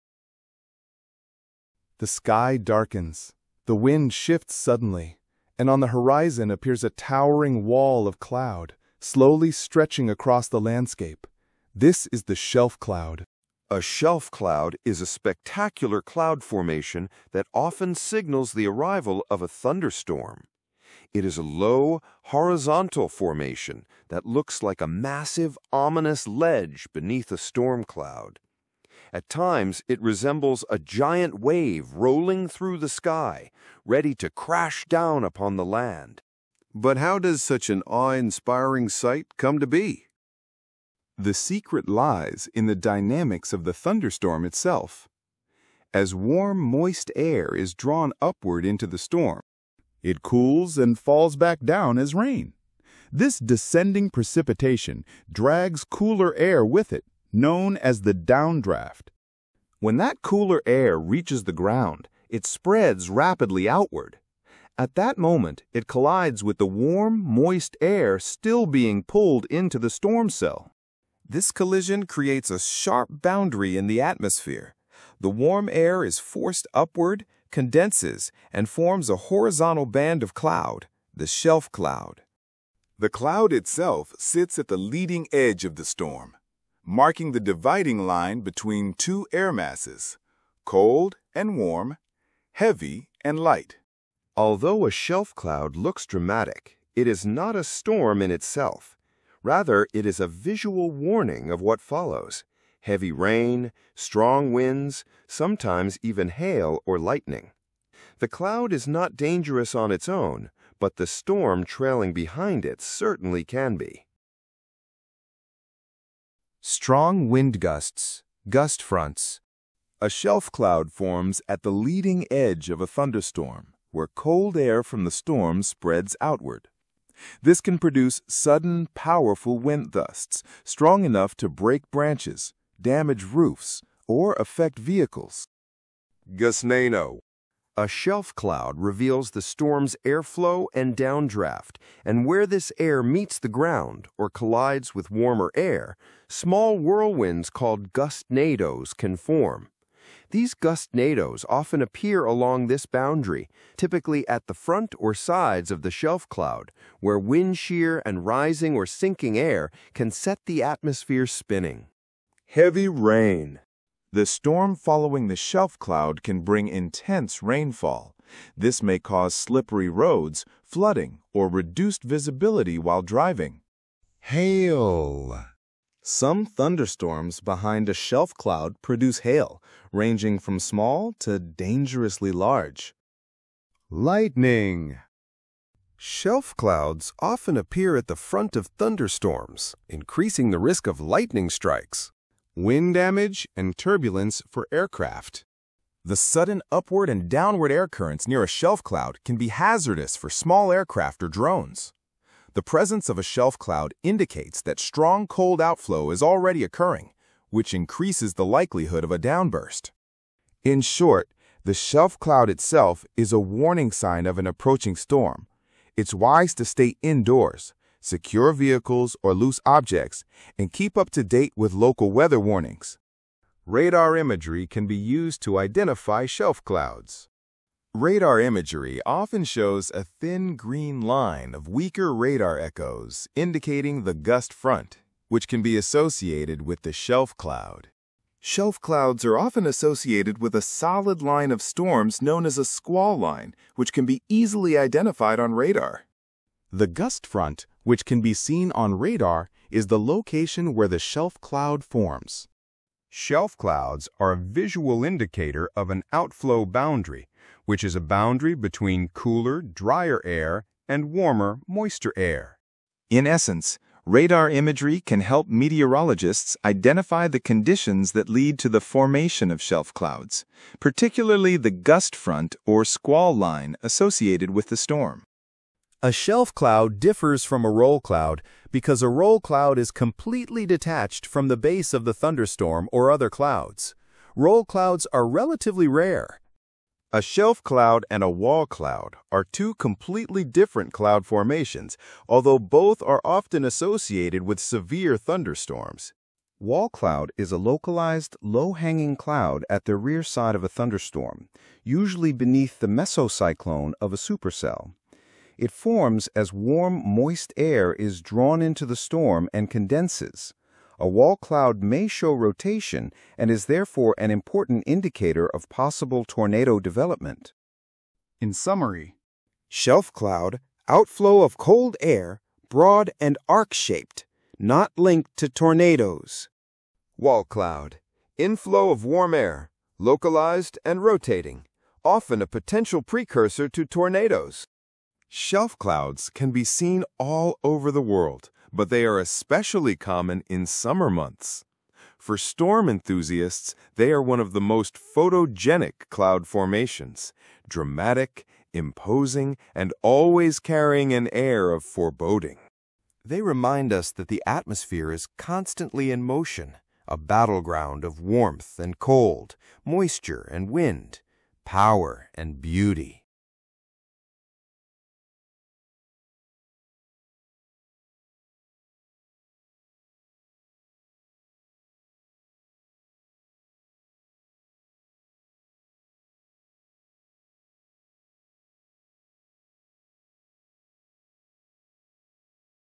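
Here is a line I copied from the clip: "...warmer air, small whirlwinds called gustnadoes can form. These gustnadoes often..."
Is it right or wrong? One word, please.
right.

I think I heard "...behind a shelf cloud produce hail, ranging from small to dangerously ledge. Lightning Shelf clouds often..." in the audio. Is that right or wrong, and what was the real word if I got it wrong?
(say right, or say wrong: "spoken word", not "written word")
wrong: "large", not "ledge".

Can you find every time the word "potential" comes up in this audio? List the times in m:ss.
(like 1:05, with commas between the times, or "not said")
5:32.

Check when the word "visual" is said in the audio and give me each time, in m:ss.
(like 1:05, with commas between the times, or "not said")
1:40, 4:14.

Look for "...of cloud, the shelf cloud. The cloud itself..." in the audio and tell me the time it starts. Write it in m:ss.
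1:20.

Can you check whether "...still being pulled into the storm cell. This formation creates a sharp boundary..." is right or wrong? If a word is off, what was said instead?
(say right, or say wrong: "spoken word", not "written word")
wrong: "collision", not "formation".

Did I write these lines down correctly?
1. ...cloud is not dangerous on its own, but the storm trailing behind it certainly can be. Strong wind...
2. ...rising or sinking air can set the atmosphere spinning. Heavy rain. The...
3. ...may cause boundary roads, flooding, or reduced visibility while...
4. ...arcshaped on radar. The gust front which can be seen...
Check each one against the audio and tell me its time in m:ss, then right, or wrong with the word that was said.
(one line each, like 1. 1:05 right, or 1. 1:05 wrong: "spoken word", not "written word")
1. 1:48 right
2. 2:38 right
3. 2:48 wrong: "slippery", not "boundary"
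4. 4:04 wrong: "identified", not "arcshaped".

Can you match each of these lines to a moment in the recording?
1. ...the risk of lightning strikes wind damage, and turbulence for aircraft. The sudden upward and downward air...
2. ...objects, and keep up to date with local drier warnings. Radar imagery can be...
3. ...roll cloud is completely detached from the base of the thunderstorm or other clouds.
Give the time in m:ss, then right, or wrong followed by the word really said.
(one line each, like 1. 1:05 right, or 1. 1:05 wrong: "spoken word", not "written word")
1. 3:10 right
2. 3:39 wrong: "weather", not "drier"
3. 4:39 right.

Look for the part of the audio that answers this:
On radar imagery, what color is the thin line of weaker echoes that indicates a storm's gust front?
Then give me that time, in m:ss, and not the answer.
3:50.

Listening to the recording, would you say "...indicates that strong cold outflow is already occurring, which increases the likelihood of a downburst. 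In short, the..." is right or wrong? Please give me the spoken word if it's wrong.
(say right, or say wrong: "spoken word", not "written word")
right.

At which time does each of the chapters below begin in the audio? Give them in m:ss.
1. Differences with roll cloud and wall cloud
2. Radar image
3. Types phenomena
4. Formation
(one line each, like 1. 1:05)
1. 4:35
2. 3:42
3. 1:54
4. 0:40.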